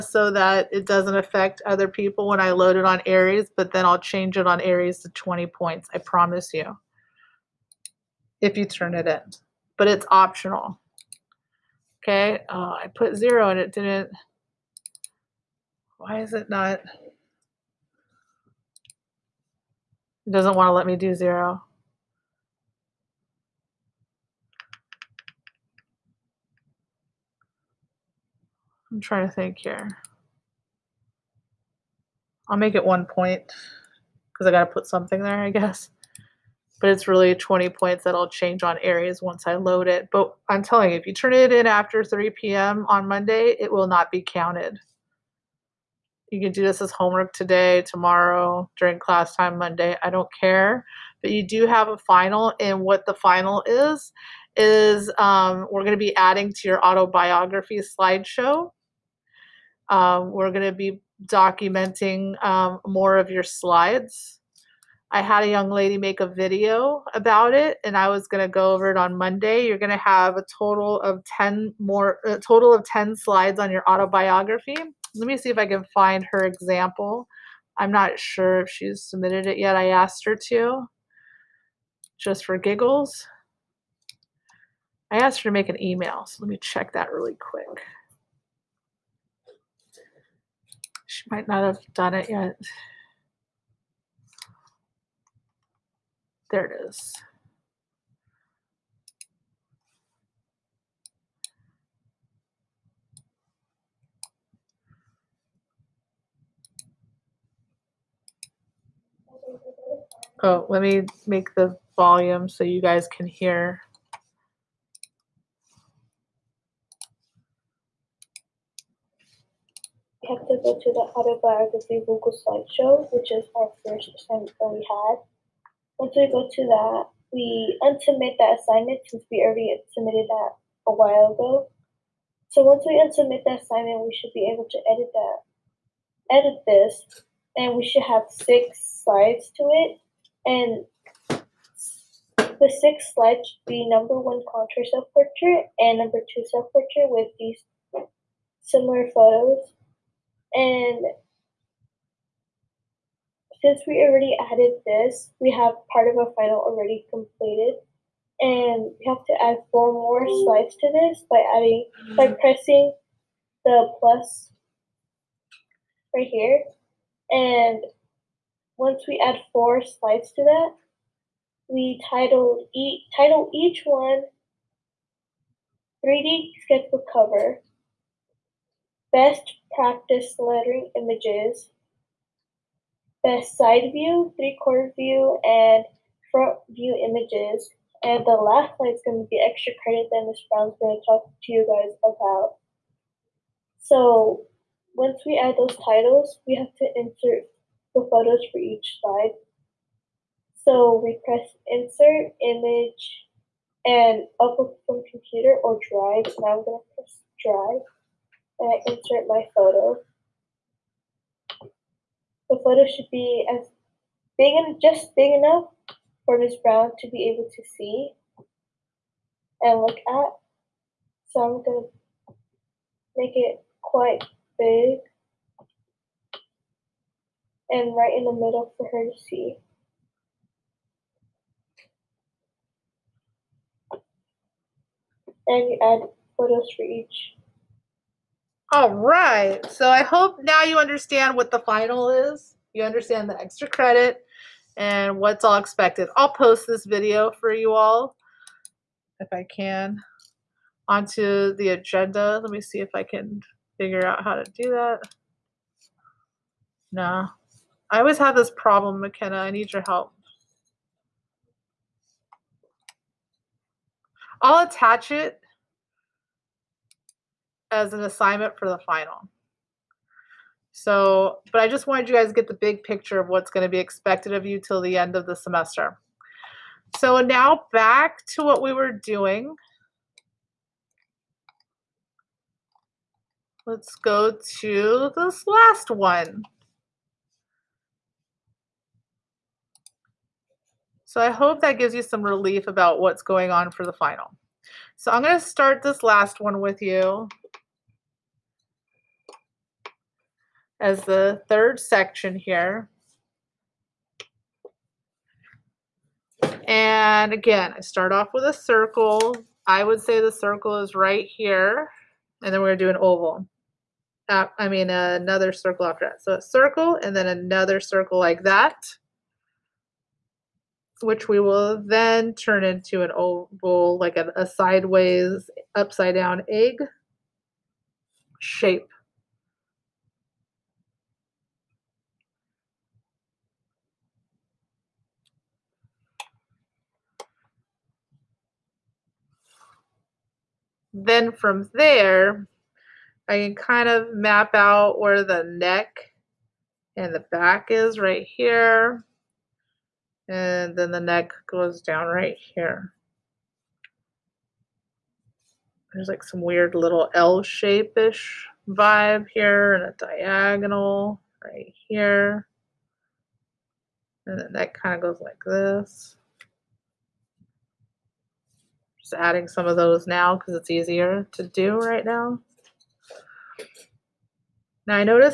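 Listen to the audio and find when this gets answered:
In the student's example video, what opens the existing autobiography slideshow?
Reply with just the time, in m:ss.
2:24.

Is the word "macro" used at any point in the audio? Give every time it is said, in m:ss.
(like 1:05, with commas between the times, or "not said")
not said.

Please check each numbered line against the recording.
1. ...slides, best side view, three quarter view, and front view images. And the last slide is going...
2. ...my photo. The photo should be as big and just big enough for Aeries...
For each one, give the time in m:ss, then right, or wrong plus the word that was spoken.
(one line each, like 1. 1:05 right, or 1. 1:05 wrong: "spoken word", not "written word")
1. 3:00 wrong: "images", not "slides"
2. 3:29 wrong: "Miss", not "Aeries".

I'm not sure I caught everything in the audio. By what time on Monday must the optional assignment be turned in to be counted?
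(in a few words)
3 p.m.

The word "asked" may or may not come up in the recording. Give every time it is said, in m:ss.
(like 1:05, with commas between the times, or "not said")
1:19, 1:25.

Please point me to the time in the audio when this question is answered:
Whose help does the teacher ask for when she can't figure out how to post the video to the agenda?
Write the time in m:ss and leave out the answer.
4:18.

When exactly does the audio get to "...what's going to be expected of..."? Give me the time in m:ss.
4:33.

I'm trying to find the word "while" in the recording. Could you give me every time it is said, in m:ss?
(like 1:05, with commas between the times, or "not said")
2:10.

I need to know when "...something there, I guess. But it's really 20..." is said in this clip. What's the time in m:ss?
0:34.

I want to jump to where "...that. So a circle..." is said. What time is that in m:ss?
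5:16.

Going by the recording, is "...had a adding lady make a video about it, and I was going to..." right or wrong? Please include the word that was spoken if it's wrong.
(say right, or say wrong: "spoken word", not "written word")
wrong: "young", not "adding".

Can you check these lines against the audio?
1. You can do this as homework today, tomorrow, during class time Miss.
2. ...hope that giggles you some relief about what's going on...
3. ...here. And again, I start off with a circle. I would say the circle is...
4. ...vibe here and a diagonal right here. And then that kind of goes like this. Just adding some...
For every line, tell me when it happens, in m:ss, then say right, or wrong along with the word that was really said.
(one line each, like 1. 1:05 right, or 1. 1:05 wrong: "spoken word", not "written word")
1. 0:46 wrong: "Monday", not "Miss"
2. 4:51 wrong: "gives", not "giggles"
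3. 5:02 right
4. 5:58 right.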